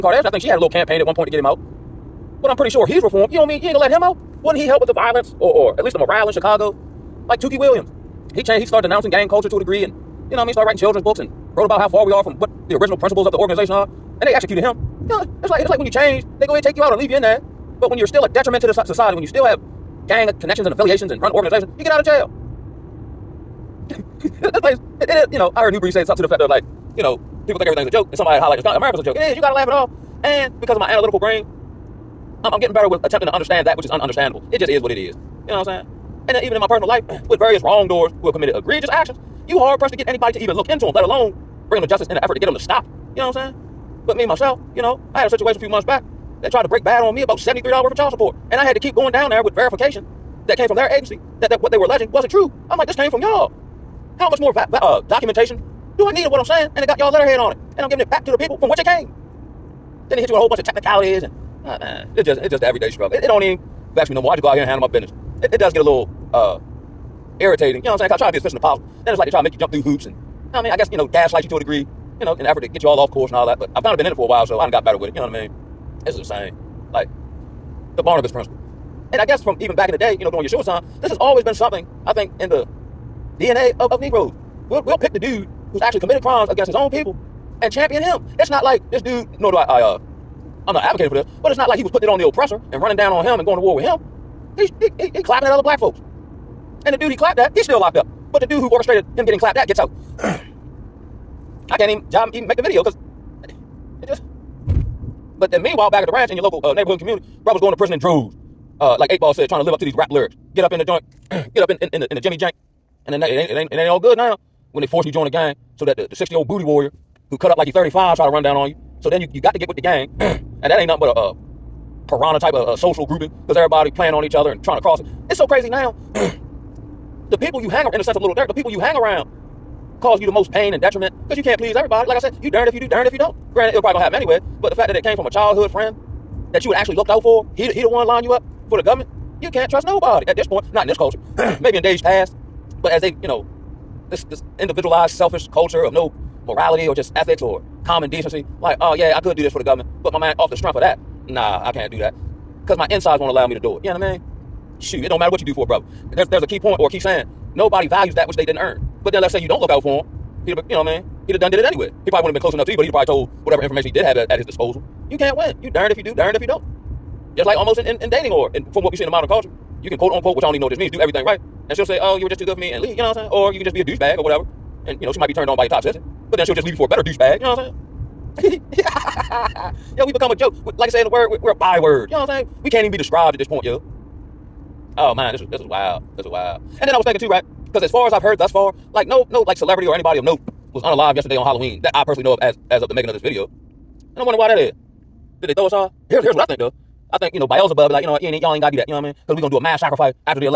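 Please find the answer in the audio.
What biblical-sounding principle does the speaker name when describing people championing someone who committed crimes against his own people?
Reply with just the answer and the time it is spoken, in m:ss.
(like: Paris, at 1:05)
the Barnabas principle, at 1:17.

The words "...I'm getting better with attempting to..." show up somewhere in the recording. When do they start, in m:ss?
0:32.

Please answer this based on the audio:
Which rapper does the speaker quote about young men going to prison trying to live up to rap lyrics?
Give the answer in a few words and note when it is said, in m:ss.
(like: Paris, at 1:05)
Eight Ball, at 1:49.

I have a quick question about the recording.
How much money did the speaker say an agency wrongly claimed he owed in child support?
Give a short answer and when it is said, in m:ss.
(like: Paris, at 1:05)
$73, at 0:47.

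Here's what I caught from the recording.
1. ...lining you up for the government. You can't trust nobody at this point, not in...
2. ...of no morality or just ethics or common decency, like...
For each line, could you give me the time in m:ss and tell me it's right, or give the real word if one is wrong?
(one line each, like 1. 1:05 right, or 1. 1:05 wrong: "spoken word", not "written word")
1. 2:18 right
2. 2:25 right.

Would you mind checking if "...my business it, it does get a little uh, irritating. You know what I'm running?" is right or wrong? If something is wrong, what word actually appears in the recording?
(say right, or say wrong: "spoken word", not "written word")
wrong: "saying", not "running".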